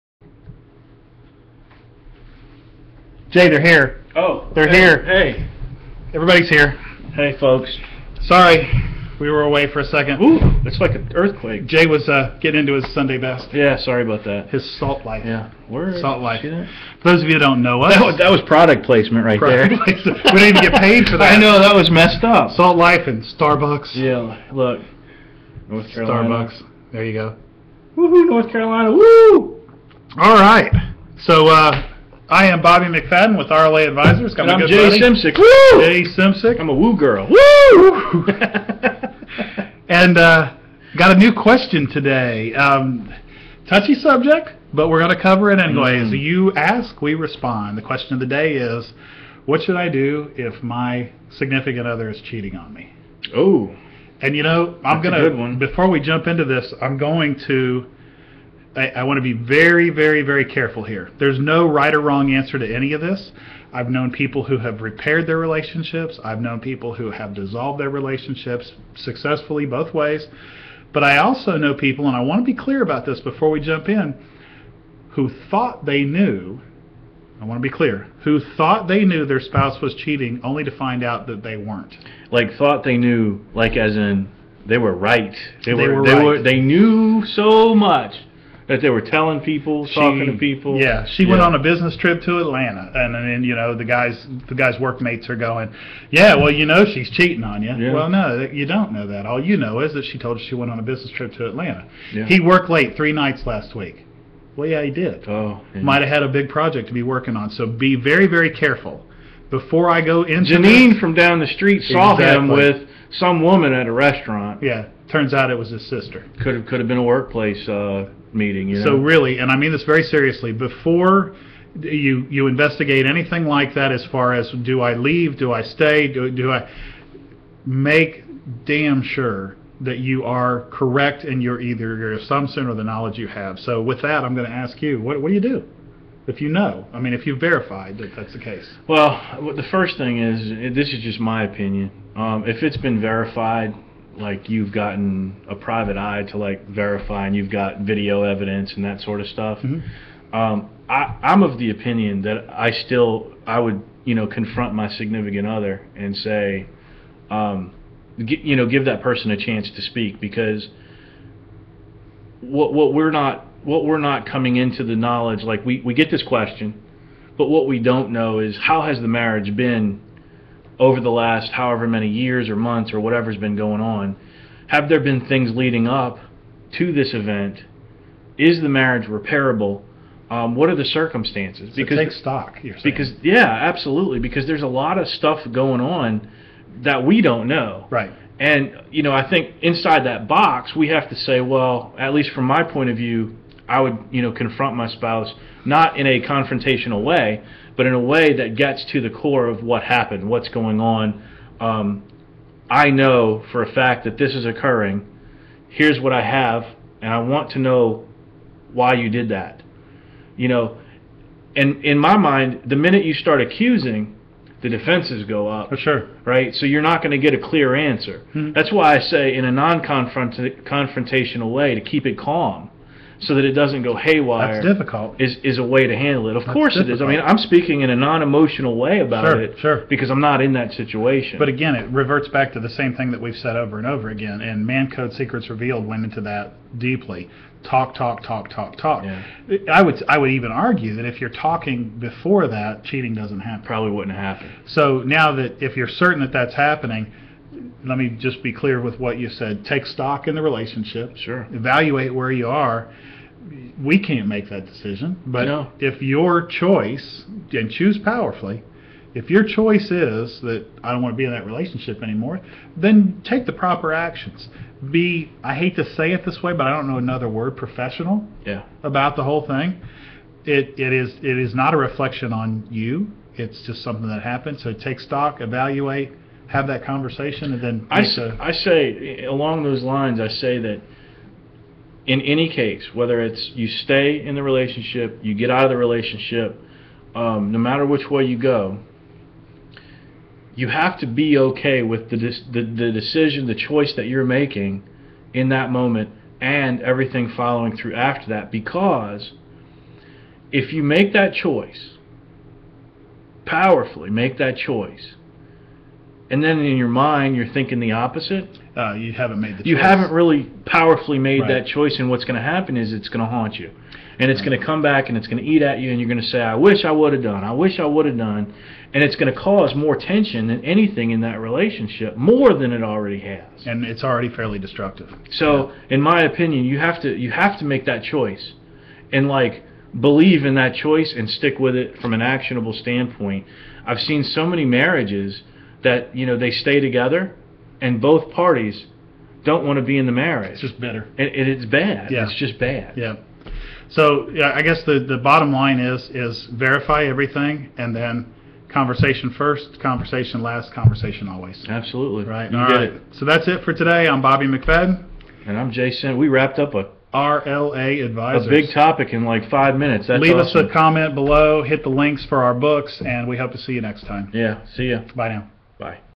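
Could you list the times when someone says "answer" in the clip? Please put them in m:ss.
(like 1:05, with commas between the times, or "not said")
1:02, 3:37.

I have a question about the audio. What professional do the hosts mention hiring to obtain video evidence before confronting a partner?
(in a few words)
A private eye.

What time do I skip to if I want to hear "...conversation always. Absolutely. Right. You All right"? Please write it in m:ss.
5:50.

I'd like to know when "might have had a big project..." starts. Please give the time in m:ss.
1:45.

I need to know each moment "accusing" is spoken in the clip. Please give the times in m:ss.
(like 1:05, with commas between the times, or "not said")
3:33.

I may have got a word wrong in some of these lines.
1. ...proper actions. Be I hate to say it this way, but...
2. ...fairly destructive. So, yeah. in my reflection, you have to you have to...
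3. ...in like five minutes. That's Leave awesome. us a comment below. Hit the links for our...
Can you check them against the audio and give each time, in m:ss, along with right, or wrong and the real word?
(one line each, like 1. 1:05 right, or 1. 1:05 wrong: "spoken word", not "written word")
1. 4:23 right
2. 5:24 wrong: "opinion", not "reflection"
3. 5:59 right.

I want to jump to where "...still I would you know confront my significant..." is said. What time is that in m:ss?
2:32.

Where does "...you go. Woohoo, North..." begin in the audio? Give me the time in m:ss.
0:27.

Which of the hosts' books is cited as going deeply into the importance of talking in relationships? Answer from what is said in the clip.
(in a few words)
Mancode Secrets Revealed.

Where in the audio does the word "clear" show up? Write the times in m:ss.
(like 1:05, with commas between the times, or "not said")
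1:12, 1:17, 3:37, 4:08.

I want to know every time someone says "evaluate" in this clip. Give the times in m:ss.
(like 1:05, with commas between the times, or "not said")
4:11, 4:35.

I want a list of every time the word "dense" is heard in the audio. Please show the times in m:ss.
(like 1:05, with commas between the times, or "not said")
not said.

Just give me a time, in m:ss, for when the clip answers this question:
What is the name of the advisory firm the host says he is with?
0:33.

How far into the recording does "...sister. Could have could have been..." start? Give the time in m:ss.
1:55.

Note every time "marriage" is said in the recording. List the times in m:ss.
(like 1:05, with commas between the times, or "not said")
2:49, 2:58, 5:34, 5:40.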